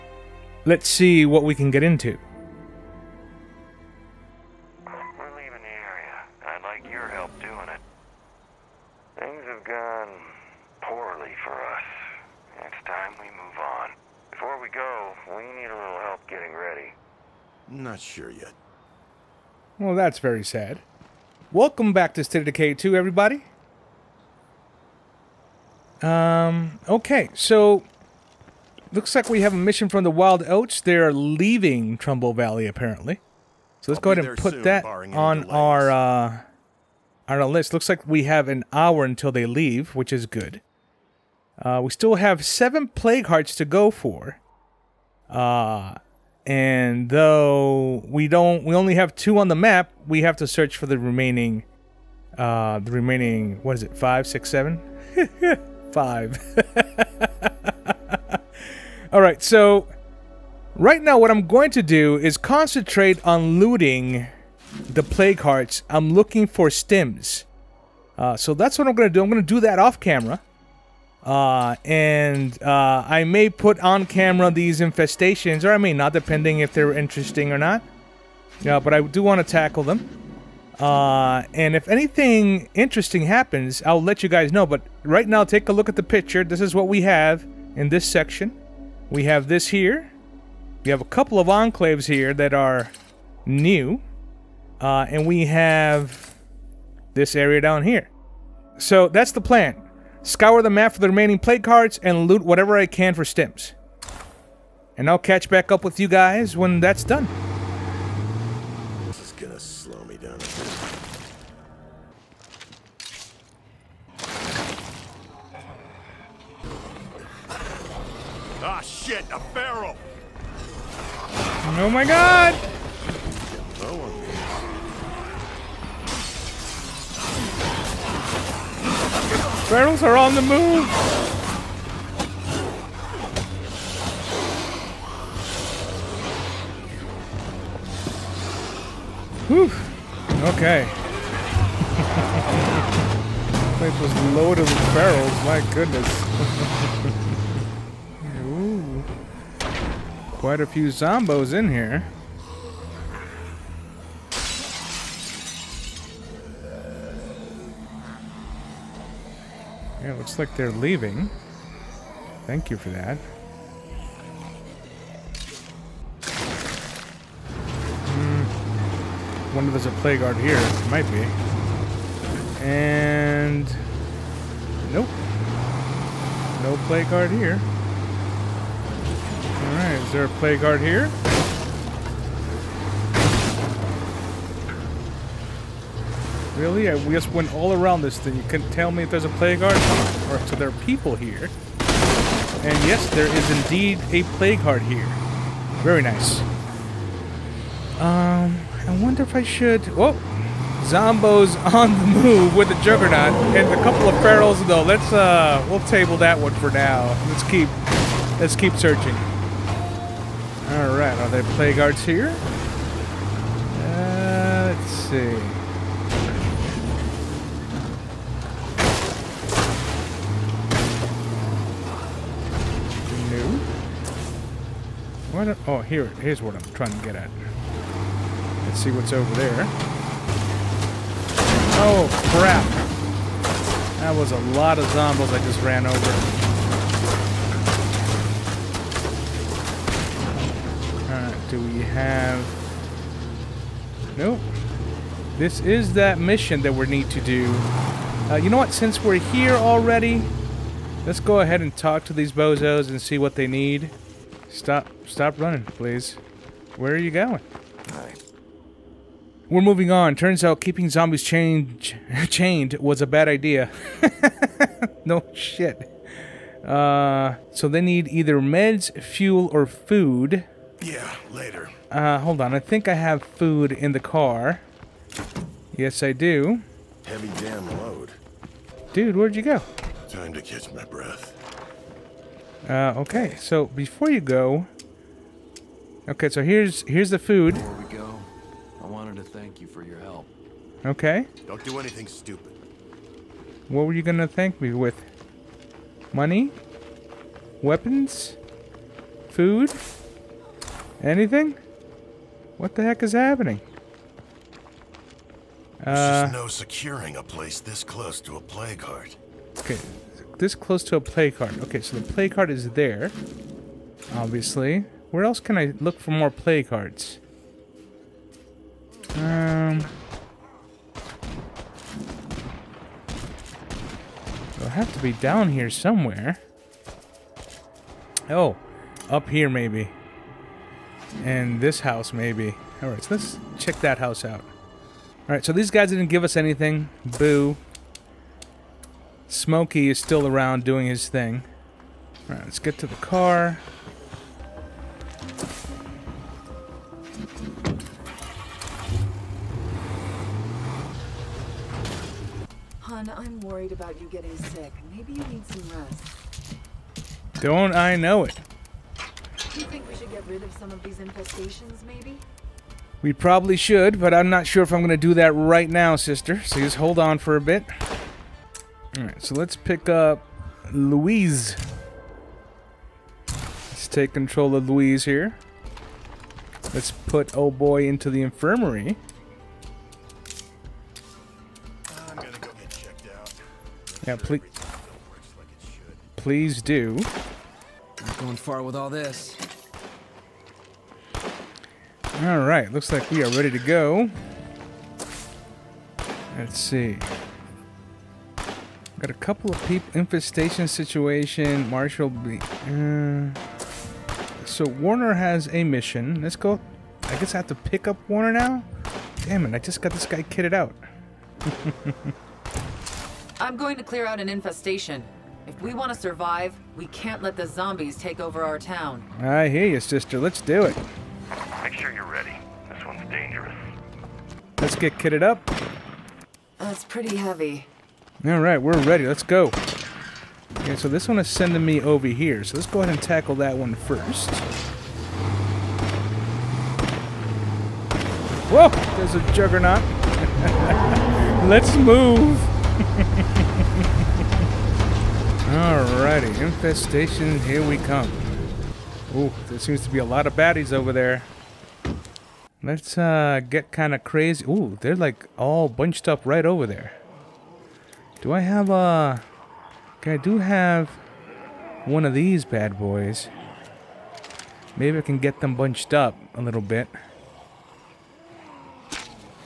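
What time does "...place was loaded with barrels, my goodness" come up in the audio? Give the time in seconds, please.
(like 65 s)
143 s.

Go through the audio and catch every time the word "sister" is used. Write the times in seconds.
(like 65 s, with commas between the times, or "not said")
365 s, 419 s.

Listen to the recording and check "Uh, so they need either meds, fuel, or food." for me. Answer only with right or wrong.
right.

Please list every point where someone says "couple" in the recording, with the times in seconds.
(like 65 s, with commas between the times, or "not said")
91 s, 203 s, 399 s.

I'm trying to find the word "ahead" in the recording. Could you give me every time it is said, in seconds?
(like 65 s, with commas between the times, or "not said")
34 s, 251 s, 432 s.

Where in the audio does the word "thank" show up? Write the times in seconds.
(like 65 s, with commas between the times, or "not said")
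162 s, 289 s, 294 s.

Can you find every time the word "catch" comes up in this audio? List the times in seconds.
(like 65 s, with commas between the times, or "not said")
105 s, 280 s.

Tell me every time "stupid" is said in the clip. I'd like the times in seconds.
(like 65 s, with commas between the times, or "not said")
292 s.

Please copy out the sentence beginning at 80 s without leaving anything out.
Uh, and if anything interesting happens, I'll let you guys know.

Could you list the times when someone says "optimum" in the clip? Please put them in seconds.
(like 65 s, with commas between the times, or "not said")
not said.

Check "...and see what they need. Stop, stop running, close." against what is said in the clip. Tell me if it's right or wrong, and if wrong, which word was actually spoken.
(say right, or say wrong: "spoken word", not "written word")
wrong: "please", not "close".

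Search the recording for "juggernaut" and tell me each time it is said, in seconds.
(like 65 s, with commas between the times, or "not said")
202 s, 439 s.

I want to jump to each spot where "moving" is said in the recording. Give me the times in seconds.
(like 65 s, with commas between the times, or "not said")
259 s.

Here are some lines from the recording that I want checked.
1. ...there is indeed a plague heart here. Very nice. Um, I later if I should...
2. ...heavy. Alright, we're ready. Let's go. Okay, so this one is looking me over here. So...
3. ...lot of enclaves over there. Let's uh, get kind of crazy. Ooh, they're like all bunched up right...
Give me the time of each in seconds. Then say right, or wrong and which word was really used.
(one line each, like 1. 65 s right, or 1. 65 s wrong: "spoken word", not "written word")
1. 193 s wrong: "wonder", not "later"
2. 427 s wrong: "sending", not "looking"
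3. 450 s wrong: "baddies", not "enclaves".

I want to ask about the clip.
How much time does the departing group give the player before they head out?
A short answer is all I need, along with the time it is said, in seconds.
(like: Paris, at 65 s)
an hour, at 38 s.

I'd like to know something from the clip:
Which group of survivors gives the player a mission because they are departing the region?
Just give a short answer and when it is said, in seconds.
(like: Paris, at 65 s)
Wild Oats, at 30 s.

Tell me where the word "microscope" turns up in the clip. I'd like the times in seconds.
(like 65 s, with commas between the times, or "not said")
not said.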